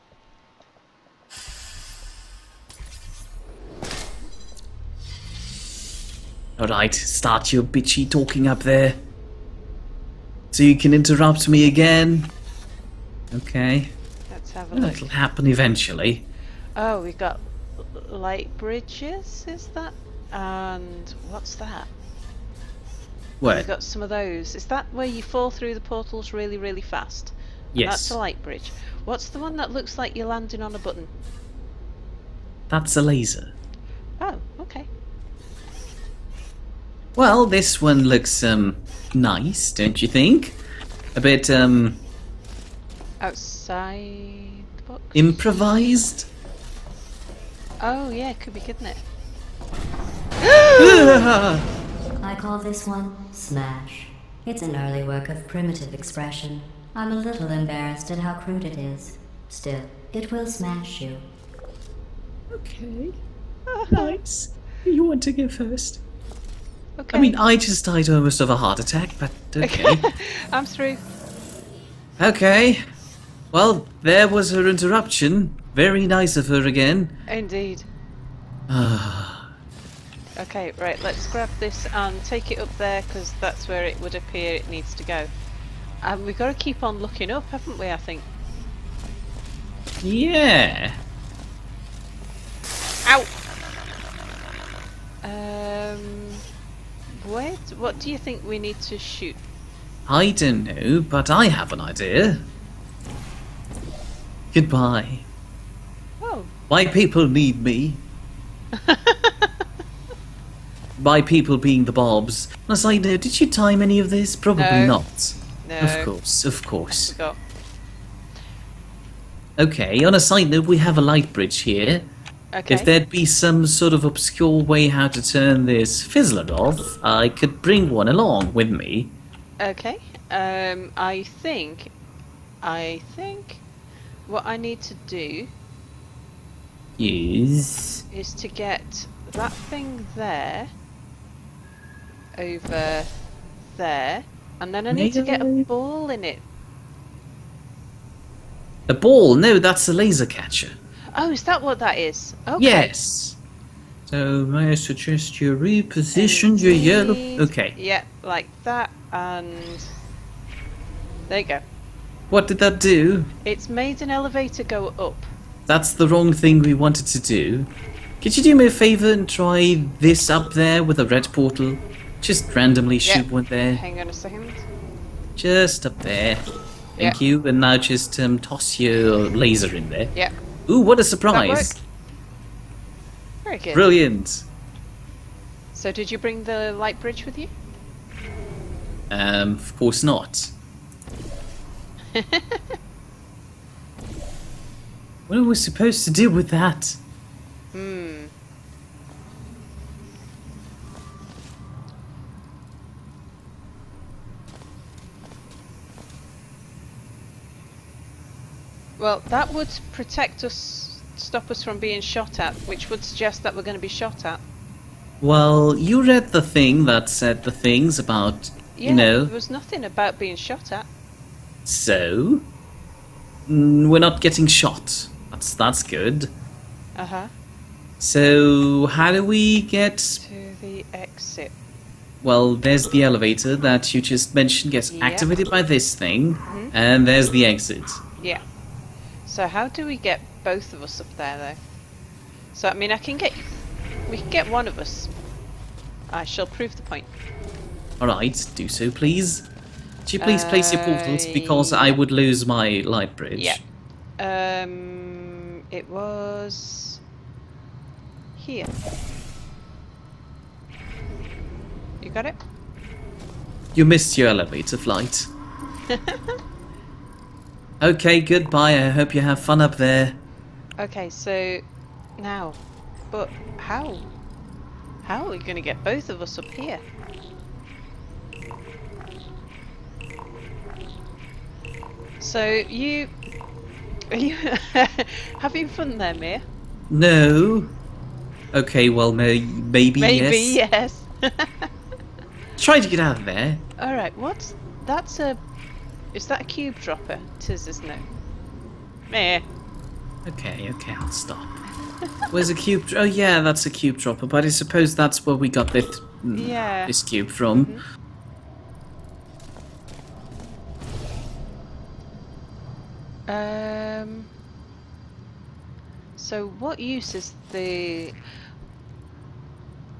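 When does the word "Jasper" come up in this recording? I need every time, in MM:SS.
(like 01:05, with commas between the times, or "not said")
not said.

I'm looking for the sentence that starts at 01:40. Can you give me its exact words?
I don't know, but I have an idea.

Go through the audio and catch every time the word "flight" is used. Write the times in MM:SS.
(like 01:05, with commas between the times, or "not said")
04:24.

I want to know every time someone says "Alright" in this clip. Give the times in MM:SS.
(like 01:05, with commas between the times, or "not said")
00:06, 04:08.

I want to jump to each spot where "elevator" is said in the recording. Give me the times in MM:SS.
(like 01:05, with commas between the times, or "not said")
02:44, 03:53, 04:24.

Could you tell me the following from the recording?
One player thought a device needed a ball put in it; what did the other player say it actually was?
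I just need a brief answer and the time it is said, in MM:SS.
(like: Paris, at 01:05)
A laser catcher, at 02:29.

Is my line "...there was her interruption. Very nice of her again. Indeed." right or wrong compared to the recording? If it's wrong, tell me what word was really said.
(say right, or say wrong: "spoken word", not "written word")
right.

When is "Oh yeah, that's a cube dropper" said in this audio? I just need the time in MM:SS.
05:02.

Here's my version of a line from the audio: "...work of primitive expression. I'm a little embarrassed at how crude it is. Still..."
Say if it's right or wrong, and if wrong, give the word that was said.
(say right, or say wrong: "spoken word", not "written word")
right.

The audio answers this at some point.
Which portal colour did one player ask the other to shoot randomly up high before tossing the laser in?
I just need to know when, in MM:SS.
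02:51.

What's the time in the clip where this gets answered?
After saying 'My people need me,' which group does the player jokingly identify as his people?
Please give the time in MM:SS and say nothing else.
01:51.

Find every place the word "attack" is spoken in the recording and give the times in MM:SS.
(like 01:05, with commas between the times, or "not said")
01:08.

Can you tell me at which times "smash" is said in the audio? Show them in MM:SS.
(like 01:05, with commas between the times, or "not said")
00:53, 01:00.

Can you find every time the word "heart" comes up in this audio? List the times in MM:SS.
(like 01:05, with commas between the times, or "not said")
01:08.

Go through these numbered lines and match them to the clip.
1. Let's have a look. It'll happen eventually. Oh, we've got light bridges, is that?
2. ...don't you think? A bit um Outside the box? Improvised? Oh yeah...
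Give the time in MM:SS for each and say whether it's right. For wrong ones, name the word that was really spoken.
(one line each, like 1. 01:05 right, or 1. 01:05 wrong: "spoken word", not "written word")
1. 00:14 right
2. 00:39 right.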